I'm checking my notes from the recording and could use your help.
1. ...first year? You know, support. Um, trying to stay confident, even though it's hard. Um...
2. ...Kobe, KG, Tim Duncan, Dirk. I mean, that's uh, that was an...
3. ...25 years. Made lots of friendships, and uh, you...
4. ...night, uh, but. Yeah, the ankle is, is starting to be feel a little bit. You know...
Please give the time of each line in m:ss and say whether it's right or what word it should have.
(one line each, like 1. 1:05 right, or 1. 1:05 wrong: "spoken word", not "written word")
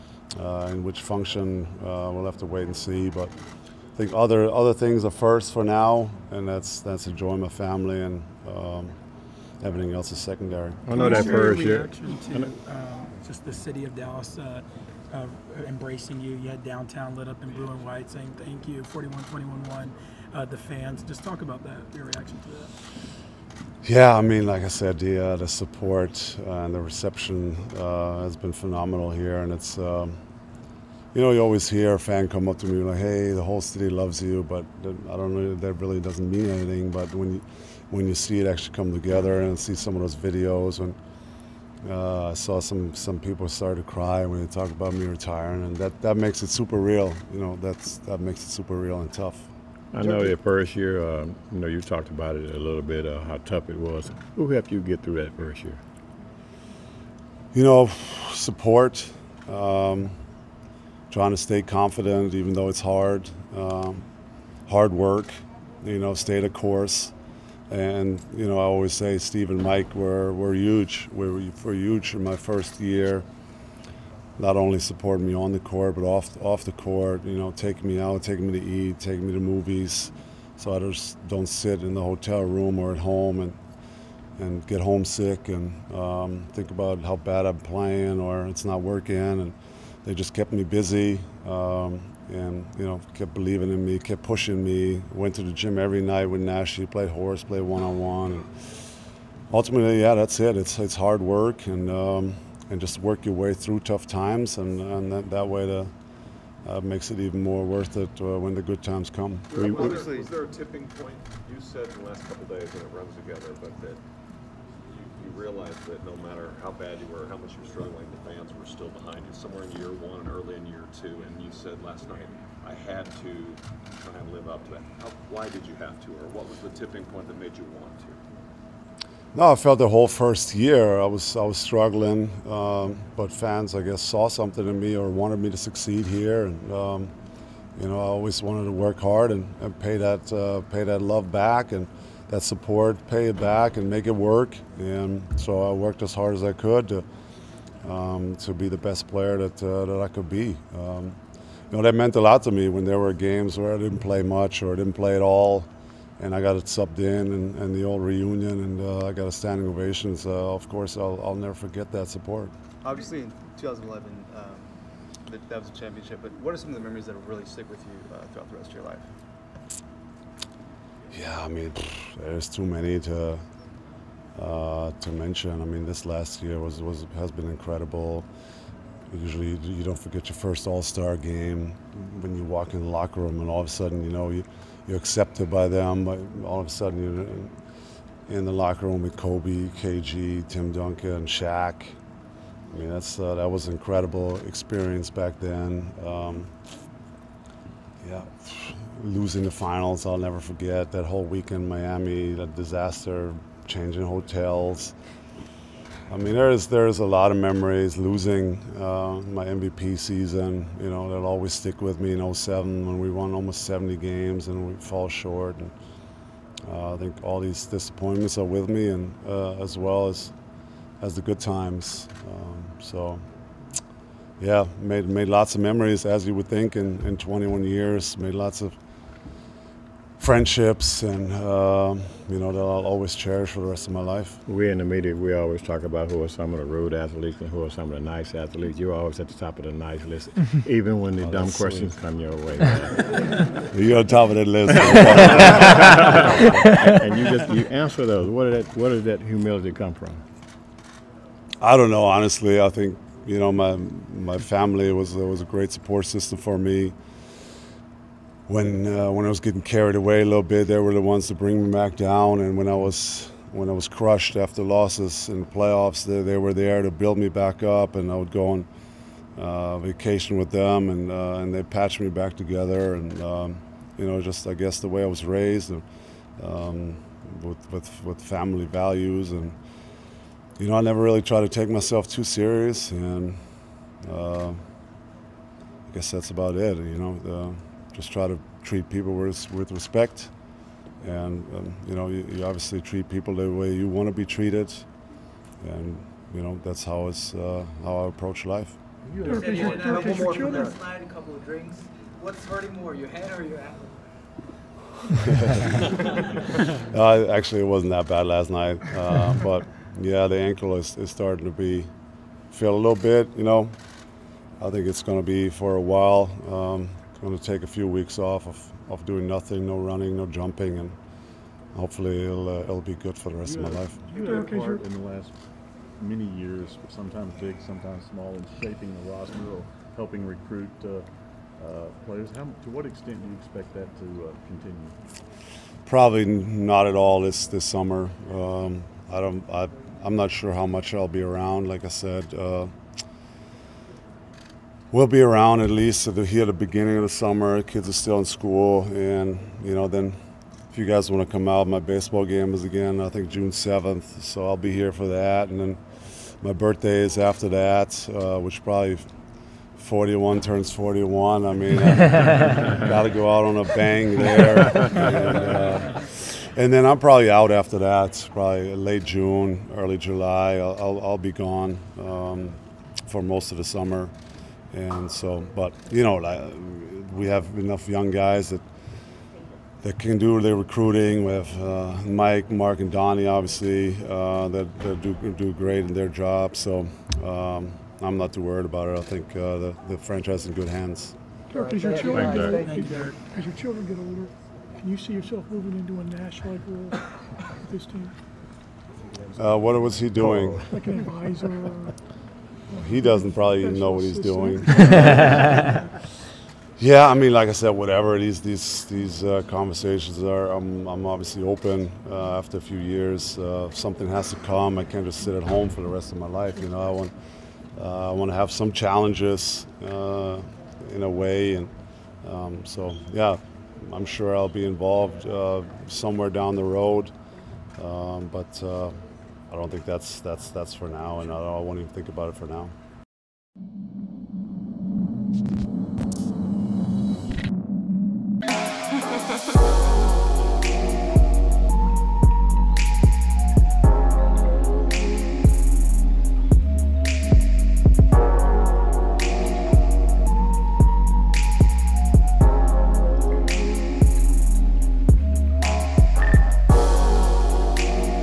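1. 0:55 right
2. 3:09 wrong: "Shaq", not "Dirk"
3. 3:47 wrong: "21", not "25"
4. 5:08 right.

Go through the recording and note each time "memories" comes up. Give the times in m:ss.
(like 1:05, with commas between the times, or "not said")
2:46, 3:27, 3:45.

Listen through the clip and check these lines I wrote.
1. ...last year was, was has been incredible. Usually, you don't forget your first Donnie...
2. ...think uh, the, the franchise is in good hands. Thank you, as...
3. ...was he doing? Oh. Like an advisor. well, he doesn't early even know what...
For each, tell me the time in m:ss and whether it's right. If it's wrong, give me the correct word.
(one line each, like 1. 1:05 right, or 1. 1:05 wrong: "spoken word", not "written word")
1. 2:56 wrong: "All", not "Donnie"
2. 6:29 right
3. 6:39 wrong: "probably", not "early".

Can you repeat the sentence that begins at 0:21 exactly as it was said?
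Just talk about that, your reaction to that.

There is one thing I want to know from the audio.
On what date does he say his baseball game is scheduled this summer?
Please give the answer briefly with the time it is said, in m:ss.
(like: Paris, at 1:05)
June 7, at 5:53.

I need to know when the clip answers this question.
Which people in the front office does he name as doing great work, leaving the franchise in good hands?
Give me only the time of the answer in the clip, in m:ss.
6:22.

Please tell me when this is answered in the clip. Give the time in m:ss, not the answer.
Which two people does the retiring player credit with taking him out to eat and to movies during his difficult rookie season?
1:09.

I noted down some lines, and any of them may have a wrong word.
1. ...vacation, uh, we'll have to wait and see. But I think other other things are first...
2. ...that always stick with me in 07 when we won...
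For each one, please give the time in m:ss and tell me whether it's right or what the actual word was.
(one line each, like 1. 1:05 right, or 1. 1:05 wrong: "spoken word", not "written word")
1. 0:01 wrong: "function", not "vacation"
2. 3:31 right.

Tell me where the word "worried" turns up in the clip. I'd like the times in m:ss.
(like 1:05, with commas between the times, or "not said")
6:28.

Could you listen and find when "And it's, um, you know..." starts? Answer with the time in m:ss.
0:29.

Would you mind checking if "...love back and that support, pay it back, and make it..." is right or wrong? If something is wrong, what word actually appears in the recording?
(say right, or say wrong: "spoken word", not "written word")
right.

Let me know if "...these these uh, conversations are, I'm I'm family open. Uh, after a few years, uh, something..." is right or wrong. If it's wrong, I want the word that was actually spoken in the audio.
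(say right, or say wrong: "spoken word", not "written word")
wrong: "obviously", not "family".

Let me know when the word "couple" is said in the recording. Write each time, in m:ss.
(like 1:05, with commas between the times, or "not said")
1:52, 5:01.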